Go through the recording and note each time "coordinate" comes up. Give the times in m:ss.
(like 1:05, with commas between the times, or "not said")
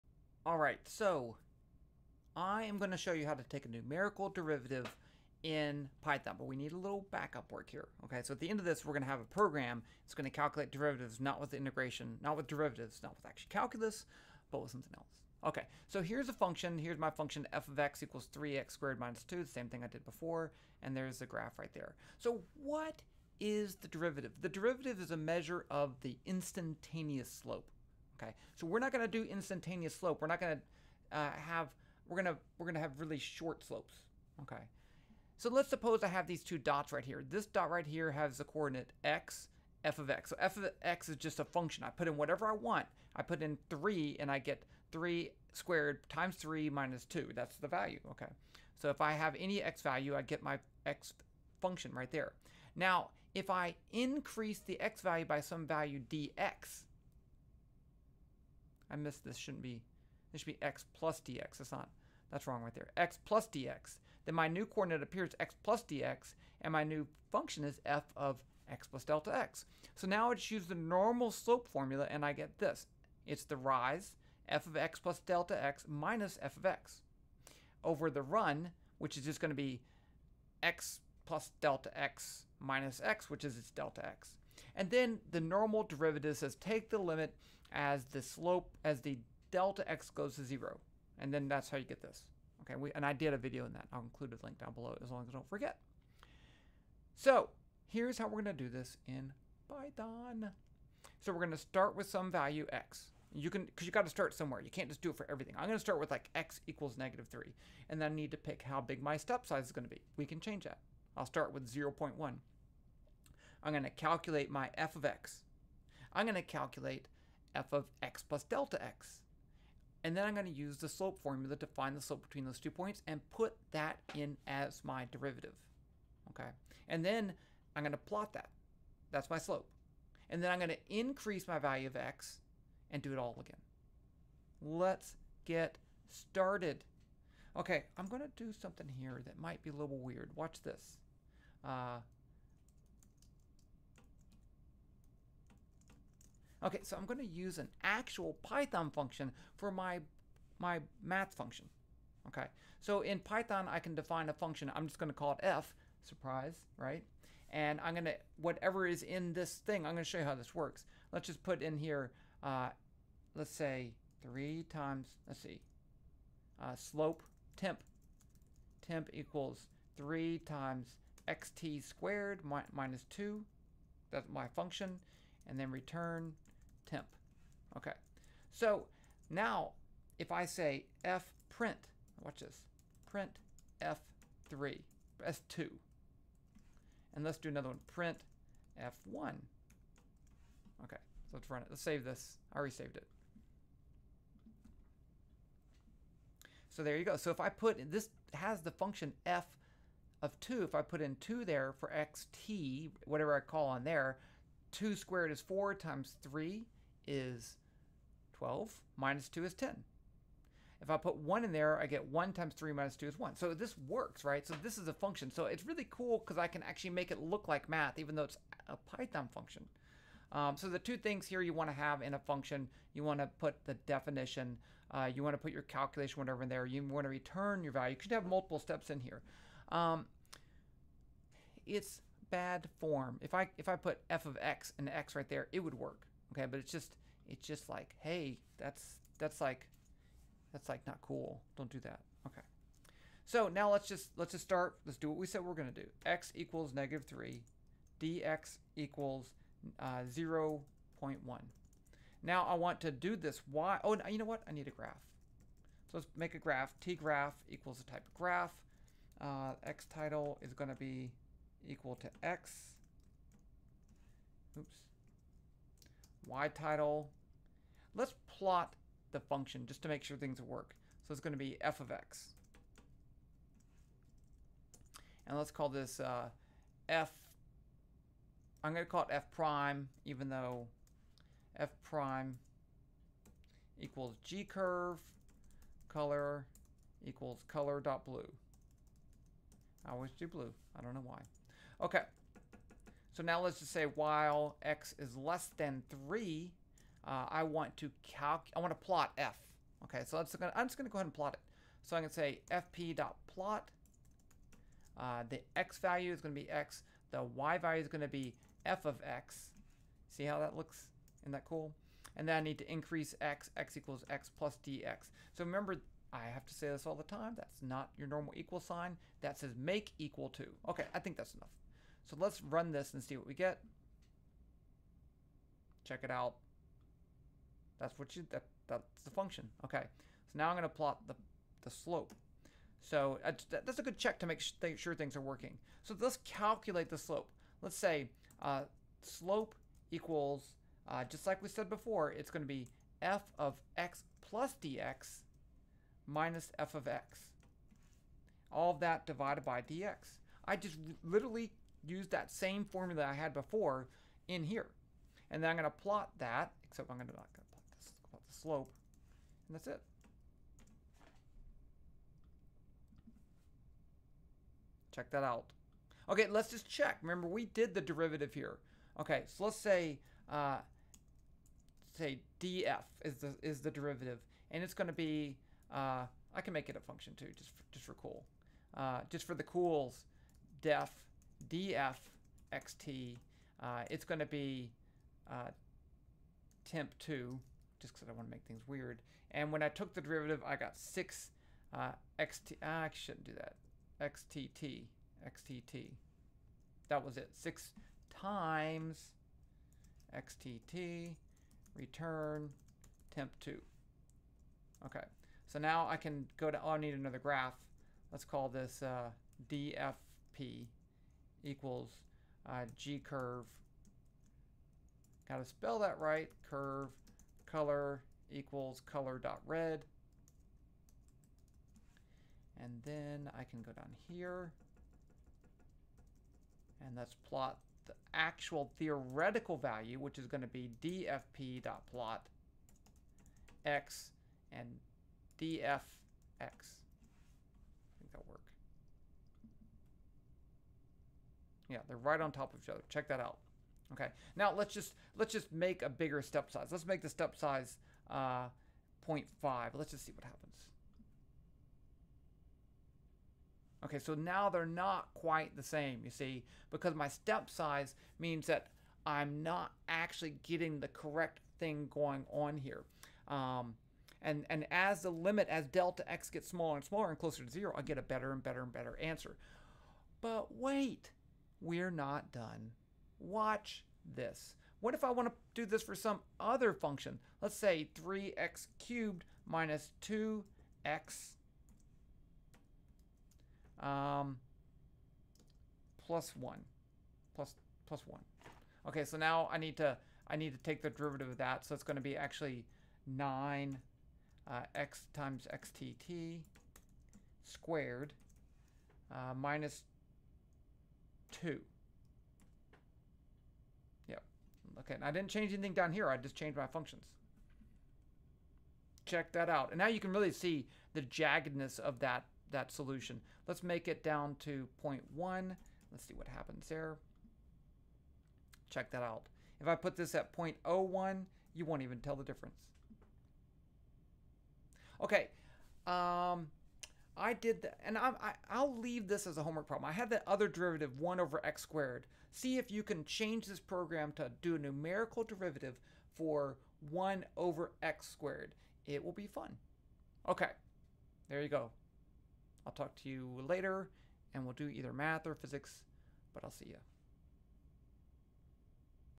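0:38, 1:04.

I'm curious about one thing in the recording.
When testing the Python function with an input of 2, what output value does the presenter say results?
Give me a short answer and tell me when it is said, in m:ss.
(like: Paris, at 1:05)
10, at 3:28.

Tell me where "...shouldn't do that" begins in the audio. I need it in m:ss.
6:32.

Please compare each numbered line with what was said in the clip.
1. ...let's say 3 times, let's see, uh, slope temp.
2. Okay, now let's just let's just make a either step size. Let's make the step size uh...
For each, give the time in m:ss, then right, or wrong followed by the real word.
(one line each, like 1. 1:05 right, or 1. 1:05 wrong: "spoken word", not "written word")
1. 2:43 right
2. 7:23 wrong: "bigger", not "either".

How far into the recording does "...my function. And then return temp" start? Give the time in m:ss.
2:54.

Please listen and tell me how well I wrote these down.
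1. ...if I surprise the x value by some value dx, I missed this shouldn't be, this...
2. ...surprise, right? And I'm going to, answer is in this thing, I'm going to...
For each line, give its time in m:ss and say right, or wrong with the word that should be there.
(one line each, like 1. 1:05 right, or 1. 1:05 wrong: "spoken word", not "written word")
1. 0:53 wrong: "increase", not "surprise"
2. 2:36 wrong: "whatever", not "answer".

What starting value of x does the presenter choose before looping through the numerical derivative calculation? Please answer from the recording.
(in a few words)
-3.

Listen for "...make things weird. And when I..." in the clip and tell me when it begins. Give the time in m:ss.
6:28.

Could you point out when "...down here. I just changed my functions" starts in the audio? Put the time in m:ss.
8:25.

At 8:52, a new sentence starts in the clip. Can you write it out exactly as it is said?
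See if you can change this program to do a numerical derivative for 1 over x squared.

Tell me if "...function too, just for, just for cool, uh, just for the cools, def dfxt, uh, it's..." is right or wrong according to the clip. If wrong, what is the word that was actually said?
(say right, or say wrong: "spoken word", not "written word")
right.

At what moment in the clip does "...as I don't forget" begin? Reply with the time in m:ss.
1:35.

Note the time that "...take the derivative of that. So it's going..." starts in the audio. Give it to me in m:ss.
8:10.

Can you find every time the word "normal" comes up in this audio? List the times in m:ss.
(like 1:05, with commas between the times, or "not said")
1:10, 1:25, 5:18.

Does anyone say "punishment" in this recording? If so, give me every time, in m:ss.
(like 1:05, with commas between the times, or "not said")
not said.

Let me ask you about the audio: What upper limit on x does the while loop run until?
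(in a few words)
3.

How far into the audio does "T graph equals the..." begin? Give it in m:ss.
4:16.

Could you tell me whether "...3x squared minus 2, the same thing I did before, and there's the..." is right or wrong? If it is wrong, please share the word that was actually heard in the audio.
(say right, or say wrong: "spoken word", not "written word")
right.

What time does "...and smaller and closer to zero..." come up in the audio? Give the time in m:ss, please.
7:46.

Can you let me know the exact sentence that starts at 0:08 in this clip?
Okay, so at the end of this, we're going to have a program.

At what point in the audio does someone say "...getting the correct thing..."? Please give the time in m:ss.
7:40.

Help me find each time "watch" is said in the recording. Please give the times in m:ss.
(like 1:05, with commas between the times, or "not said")
2:20, 3:02, 7:53.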